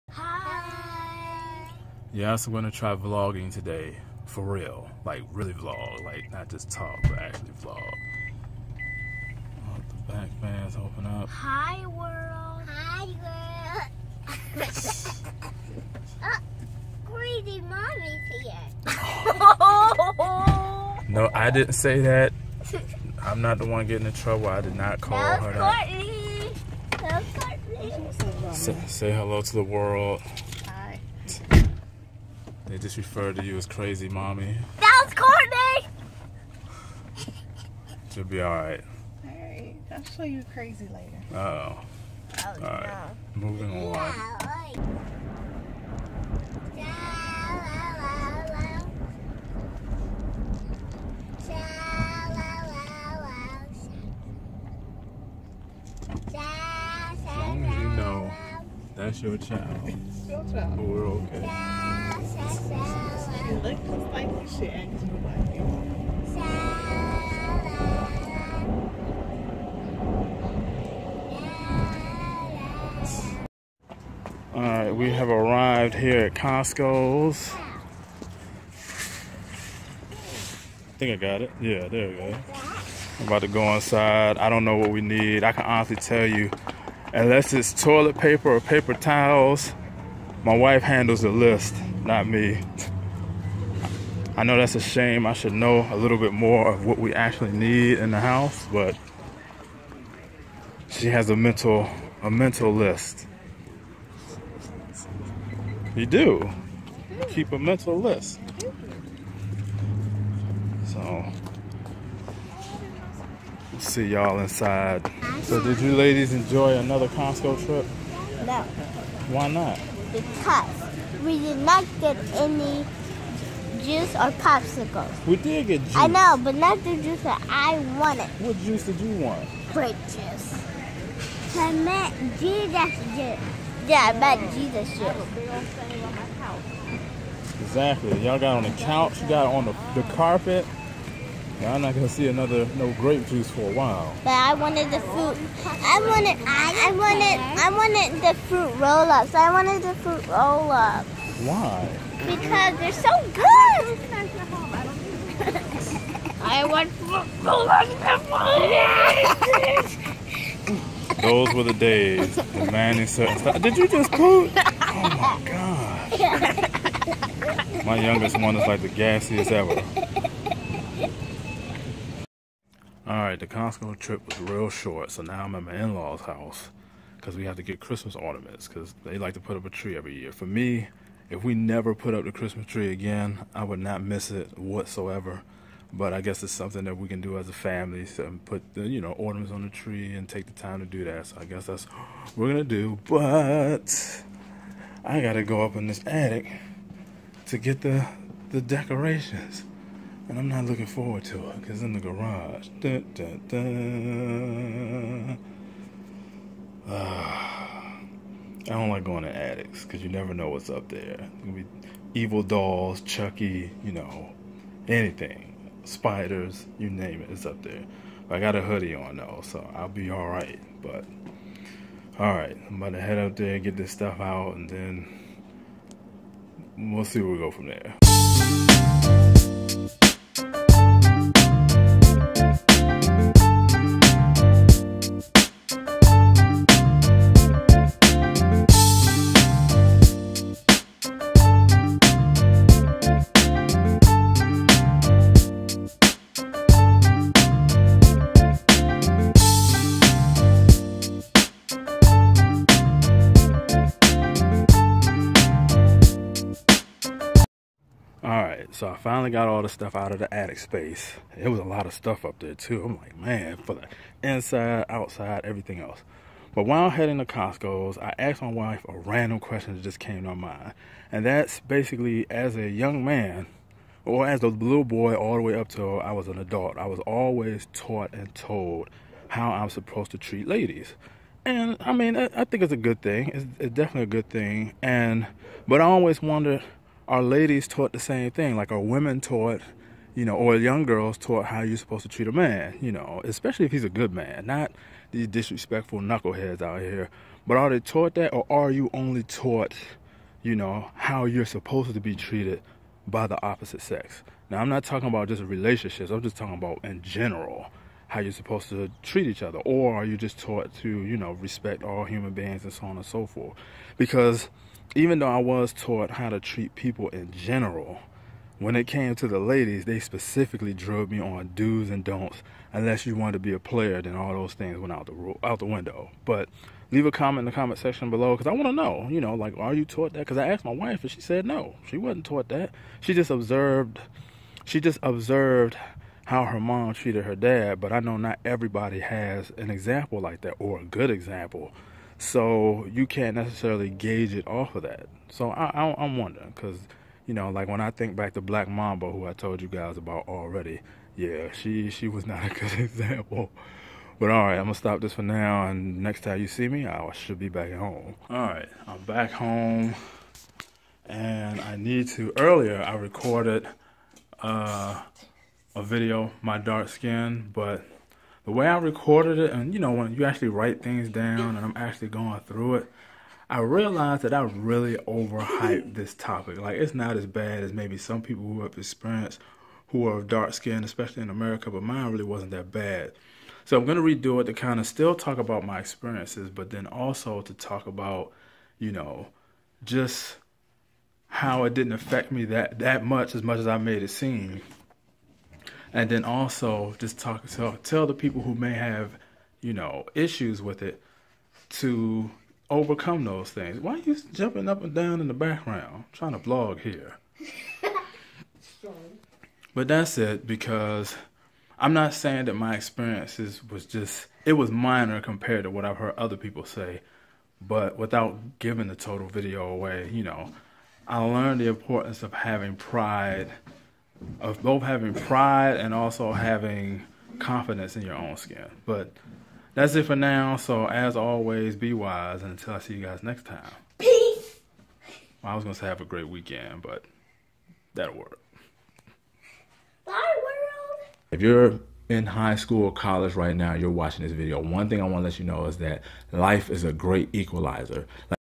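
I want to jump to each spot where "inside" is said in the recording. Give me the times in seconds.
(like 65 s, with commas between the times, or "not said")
83 s, 114 s, 264 s.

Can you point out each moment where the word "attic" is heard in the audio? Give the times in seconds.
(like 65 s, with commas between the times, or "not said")
196 s, 209 s, 260 s.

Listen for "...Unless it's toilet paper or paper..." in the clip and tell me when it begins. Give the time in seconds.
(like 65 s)
87 s.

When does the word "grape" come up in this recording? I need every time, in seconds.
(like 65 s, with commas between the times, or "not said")
129 s, 142 s.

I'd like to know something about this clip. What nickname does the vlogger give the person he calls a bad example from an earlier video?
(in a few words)
Black Mamba.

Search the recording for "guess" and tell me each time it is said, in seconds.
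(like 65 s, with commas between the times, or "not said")
186 s, 191 s.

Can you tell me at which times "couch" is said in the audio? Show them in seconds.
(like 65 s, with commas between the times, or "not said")
138 s.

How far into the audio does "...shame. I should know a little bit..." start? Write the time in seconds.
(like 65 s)
94 s.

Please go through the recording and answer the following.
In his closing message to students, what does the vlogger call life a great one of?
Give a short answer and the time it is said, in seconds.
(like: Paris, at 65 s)
Equalizer, at 447 s.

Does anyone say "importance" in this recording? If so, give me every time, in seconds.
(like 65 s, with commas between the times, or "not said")
421 s.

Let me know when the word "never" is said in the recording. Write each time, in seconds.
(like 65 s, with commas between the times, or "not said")
181 s, 210 s.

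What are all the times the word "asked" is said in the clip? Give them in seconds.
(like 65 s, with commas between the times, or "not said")
268 s, 330 s.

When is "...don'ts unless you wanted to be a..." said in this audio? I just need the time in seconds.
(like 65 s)
322 s.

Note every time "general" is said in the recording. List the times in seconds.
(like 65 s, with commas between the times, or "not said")
307 s, 317 s.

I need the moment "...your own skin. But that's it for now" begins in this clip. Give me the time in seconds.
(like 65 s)
428 s.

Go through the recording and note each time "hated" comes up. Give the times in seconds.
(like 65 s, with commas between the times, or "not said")
not said.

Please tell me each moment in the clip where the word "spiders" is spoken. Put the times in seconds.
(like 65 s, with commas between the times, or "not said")
215 s.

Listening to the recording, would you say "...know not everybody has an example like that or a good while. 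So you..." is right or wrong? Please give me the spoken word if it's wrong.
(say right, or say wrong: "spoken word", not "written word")
wrong: "example", not "while".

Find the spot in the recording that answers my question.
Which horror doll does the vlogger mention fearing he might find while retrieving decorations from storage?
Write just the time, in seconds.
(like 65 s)
213 s.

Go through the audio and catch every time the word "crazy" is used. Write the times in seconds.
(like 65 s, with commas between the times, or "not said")
33 s, 40 s.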